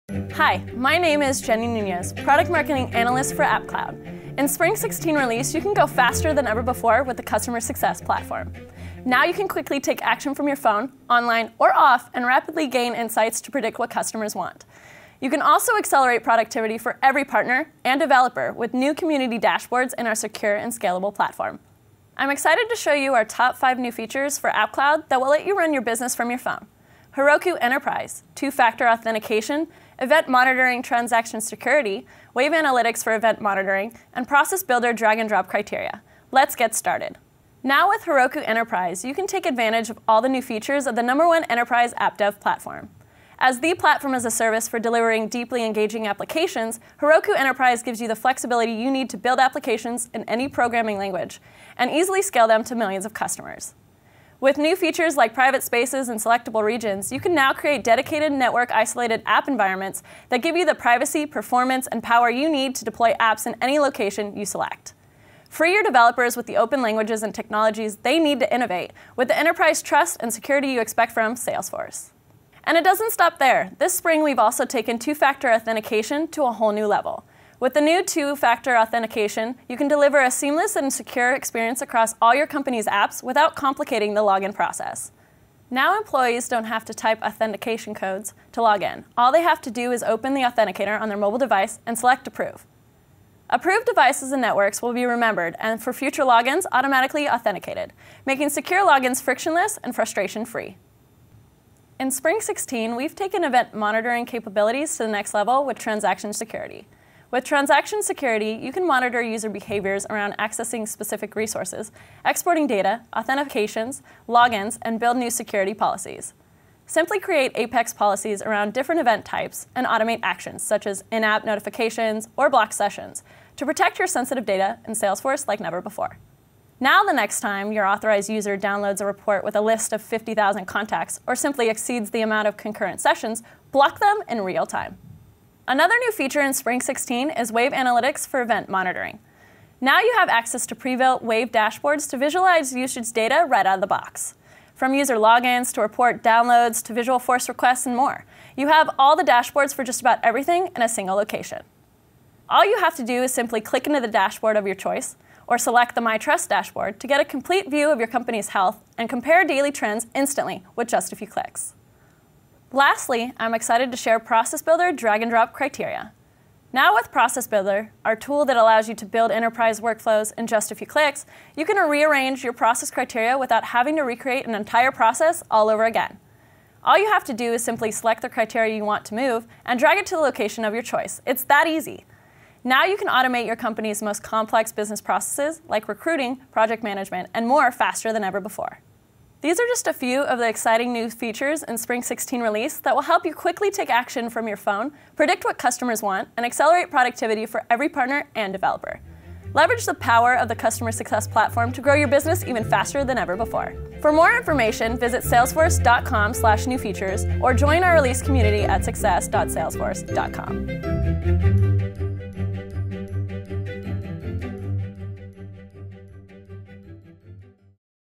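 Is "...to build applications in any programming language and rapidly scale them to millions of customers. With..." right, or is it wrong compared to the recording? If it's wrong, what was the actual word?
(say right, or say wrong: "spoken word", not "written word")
wrong: "easily", not "rapidly".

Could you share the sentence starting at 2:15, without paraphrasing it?
Another new feature in Spring 16 is Wave Analytics for event monitoring.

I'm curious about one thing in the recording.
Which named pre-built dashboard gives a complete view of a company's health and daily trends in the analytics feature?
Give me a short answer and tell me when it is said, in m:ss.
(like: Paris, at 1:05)
My Trust, at 2:36.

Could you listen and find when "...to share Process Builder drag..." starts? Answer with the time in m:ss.
2:43.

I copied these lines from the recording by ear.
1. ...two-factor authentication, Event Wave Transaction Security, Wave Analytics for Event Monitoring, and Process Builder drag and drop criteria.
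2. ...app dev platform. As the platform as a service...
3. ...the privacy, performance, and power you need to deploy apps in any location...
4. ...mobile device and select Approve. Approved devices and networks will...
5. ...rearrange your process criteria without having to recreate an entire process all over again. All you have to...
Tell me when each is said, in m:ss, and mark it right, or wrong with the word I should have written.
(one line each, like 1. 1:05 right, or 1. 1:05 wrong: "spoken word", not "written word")
1. 0:28 wrong: "Monitoring", not "Wave"
2. 0:41 right
3. 1:00 right
4. 1:31 right
5. 2:51 right.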